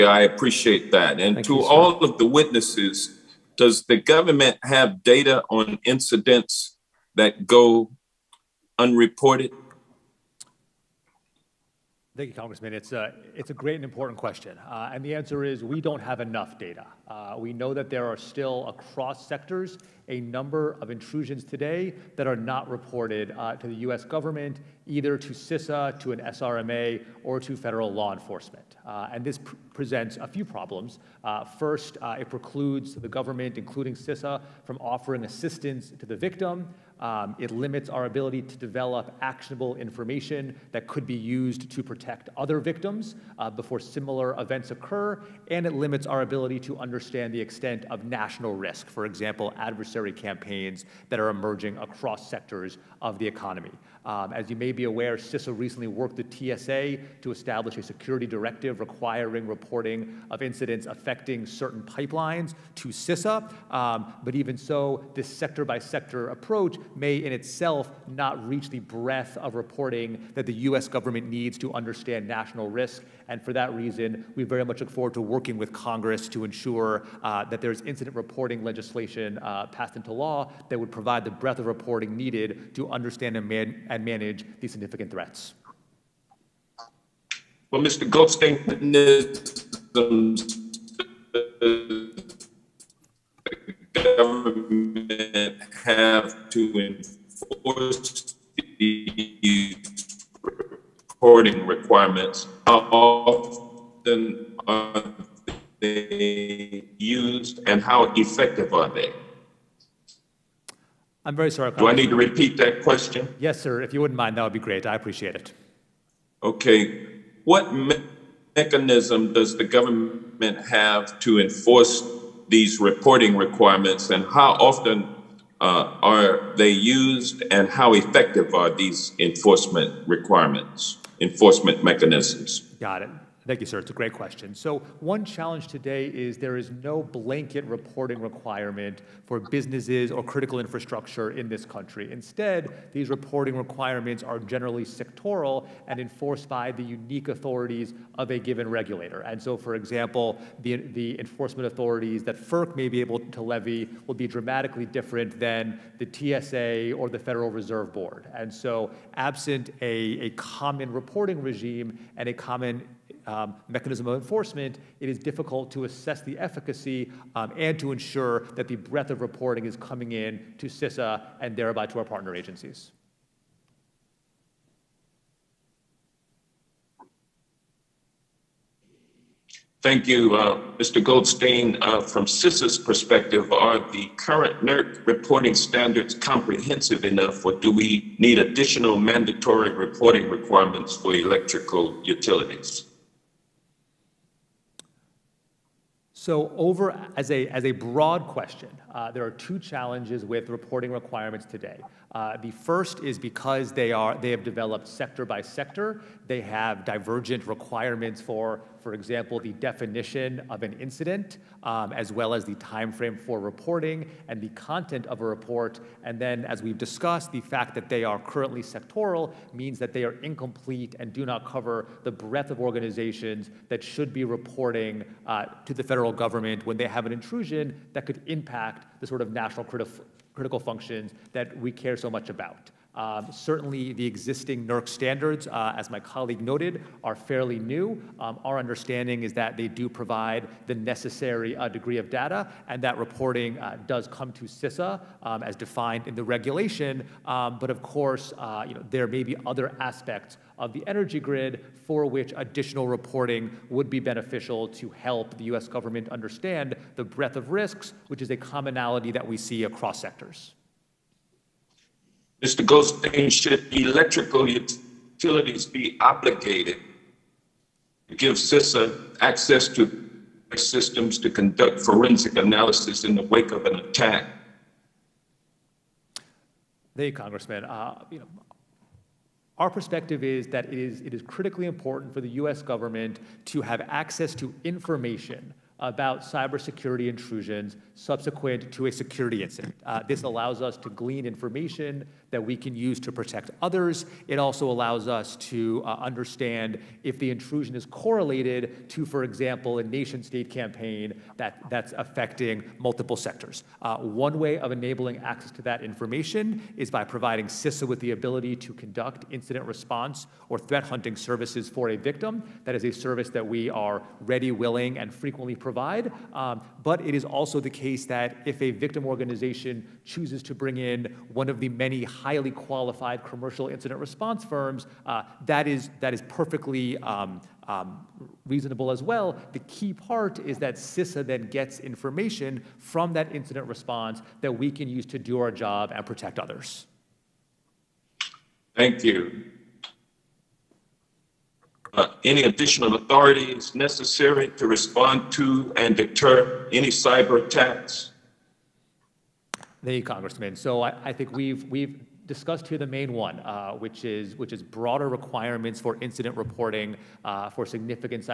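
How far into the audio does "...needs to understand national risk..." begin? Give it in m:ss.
1:11.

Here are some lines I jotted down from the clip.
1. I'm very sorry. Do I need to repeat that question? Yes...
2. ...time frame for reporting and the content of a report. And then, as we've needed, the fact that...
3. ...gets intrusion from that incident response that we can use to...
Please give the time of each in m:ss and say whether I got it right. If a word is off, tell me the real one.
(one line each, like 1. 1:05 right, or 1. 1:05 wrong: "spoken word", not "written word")
1. 1:51 right
2. 3:32 wrong: "discussed", not "needed"
3. 5:31 wrong: "information", not "intrusion".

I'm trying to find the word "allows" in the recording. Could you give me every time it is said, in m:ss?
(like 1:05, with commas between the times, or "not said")
4:50, 4:54.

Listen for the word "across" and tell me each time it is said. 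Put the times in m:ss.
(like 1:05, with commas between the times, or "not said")
0:18, 0:51, 4:19.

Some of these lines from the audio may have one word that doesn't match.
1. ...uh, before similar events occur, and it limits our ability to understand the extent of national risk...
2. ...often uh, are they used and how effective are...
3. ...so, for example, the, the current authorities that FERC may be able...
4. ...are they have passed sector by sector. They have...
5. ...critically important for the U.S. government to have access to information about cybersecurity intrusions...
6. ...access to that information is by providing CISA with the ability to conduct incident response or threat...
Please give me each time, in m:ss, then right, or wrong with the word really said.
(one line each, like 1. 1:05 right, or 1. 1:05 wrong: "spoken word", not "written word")
1. 0:43 right
2. 2:04 right
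3. 2:29 wrong: "enforcement", not "current"
4. 3:23 wrong: "developed", not "passed"
5. 4:41 right
6. 5:05 right.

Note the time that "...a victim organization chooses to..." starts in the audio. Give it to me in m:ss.
5:18.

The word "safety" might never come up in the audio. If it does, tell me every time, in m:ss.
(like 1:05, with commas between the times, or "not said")
not said.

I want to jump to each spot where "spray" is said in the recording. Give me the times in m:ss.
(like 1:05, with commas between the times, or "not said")
not said.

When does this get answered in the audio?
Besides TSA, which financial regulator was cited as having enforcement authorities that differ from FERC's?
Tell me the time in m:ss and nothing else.
2:37.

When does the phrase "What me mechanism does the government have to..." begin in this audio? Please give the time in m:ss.
1:57.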